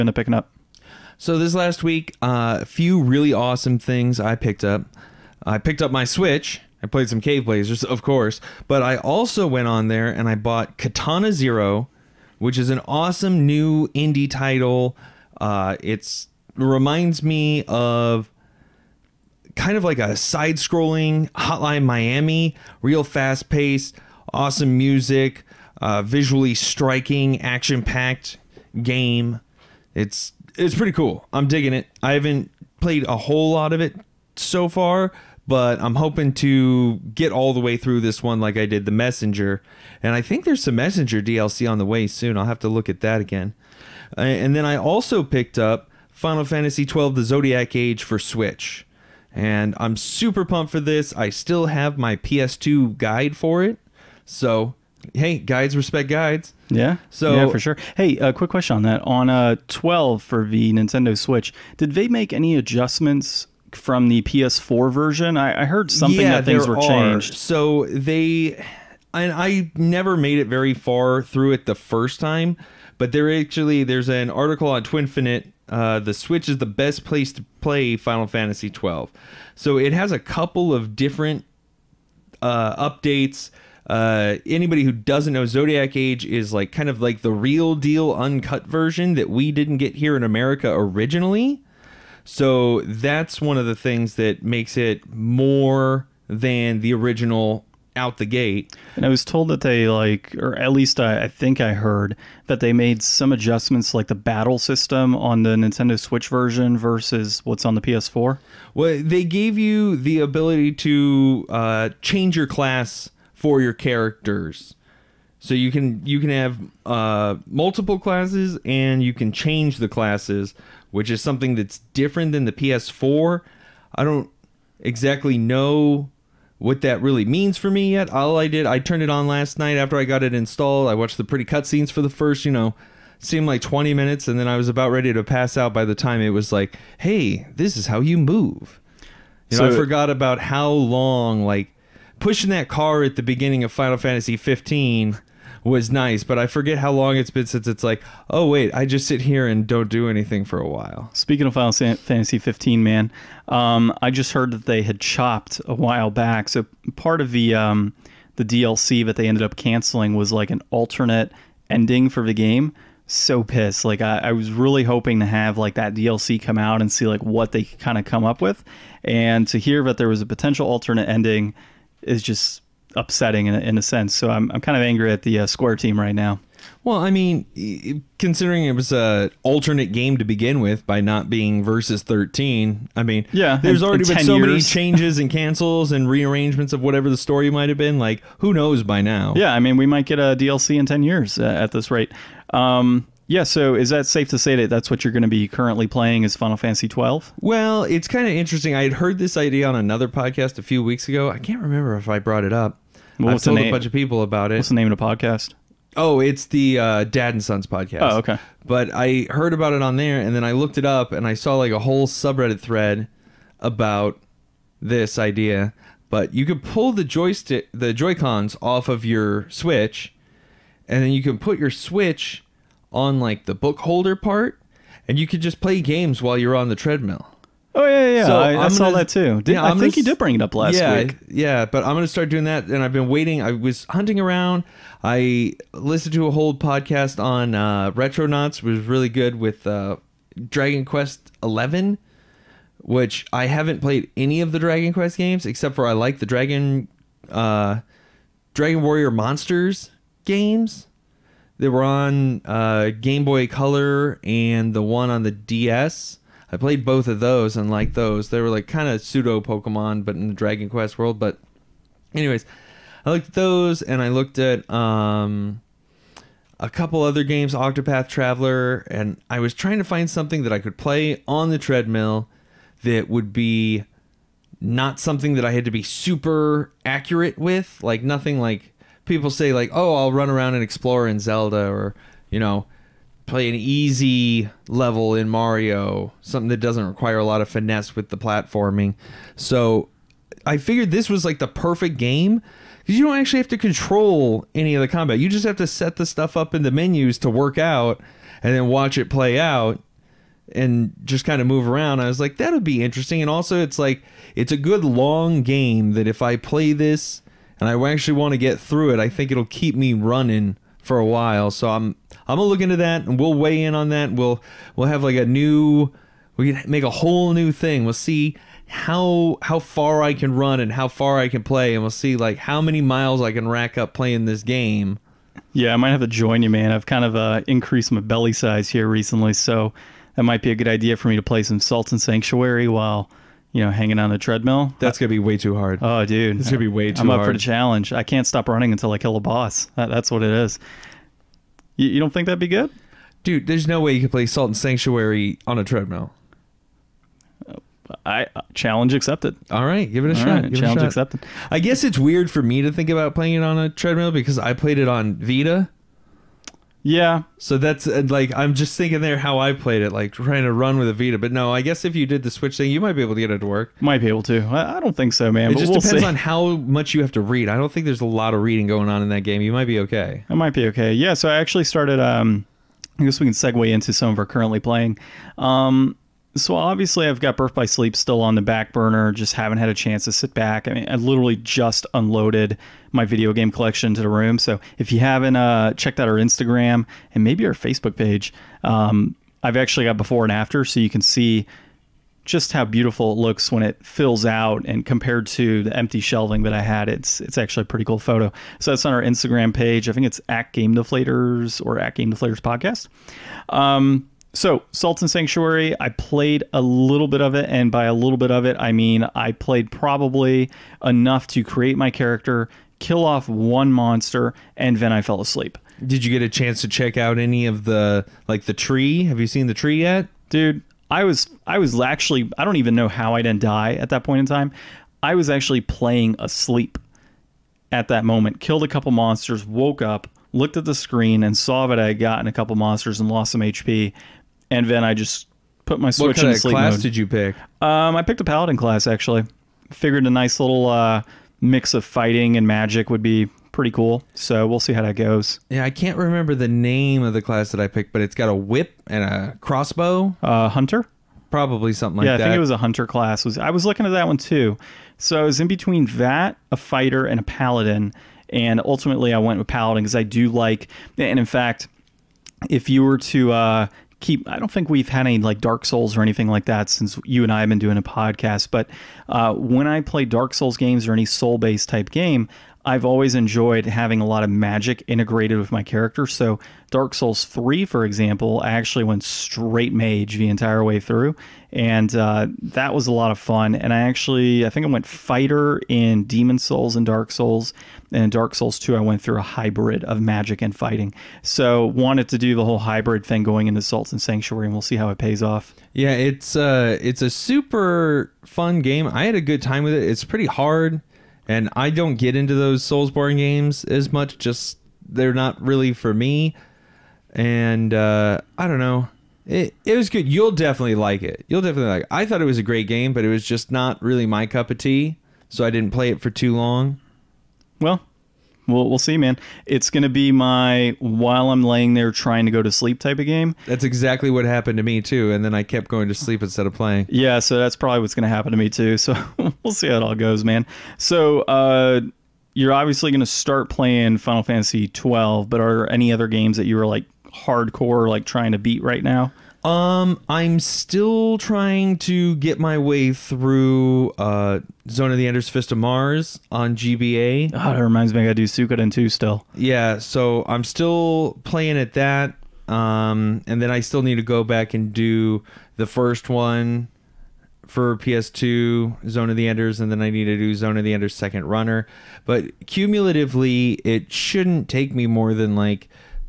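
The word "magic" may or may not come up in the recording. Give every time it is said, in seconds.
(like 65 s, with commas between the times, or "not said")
442 s, 474 s, 489 s.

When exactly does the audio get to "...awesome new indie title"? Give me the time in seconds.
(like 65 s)
12 s.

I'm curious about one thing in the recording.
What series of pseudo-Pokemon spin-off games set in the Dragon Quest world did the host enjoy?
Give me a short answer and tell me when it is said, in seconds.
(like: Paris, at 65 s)
Dragon Warrior Monsters, at 248 s.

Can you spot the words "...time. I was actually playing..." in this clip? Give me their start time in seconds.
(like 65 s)
424 s.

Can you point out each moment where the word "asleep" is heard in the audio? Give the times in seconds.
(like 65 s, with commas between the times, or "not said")
415 s, 426 s.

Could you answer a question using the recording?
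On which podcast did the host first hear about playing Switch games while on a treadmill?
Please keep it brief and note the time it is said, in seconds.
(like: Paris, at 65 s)
Dad and Sons podcast, at 207 s.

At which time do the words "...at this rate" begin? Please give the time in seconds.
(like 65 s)
191 s.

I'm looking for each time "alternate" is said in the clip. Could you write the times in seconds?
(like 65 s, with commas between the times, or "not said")
160 s, 170 s, 179 s.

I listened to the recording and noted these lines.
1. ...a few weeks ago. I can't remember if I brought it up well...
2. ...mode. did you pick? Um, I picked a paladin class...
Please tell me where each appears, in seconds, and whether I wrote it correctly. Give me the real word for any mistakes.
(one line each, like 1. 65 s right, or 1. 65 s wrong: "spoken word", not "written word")
1. 200 s right
2. 436 s right.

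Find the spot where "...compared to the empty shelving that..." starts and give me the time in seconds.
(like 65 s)
394 s.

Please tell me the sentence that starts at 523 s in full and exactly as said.
That's exactly what happened to me, too.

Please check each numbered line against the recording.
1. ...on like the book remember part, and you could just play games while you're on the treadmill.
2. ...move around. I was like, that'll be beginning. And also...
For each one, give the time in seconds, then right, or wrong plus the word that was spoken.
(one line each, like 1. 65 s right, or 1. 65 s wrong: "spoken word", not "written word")
1. 222 s wrong: "holder", not "remember"
2. 301 s wrong: "interesting", not "beginning".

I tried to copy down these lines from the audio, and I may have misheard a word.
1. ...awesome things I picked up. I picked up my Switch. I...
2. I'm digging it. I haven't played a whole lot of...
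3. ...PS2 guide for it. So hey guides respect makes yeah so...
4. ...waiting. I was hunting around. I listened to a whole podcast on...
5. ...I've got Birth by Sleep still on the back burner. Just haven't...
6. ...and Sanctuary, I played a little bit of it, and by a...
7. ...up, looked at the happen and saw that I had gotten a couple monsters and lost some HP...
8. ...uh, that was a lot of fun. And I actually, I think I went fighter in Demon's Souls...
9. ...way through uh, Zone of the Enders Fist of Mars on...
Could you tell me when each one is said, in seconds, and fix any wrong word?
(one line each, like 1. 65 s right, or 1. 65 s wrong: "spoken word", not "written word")
1. 3 s right
2. 31 s right
3. 52 s wrong: "guides", not "makes"
4. 233 s right
5. 377 s right
6. 405 s right
7. 429 s wrong: "screen", not "happen"
8. 481 s right
9. 542 s right.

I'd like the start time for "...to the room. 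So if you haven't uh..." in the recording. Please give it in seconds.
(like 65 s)
383 s.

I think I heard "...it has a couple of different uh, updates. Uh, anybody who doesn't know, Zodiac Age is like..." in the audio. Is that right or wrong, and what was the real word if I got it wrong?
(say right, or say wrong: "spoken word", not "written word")
right.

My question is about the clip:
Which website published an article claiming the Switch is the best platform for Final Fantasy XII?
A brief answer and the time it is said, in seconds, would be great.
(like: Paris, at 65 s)
Twinfinite, at 74 s.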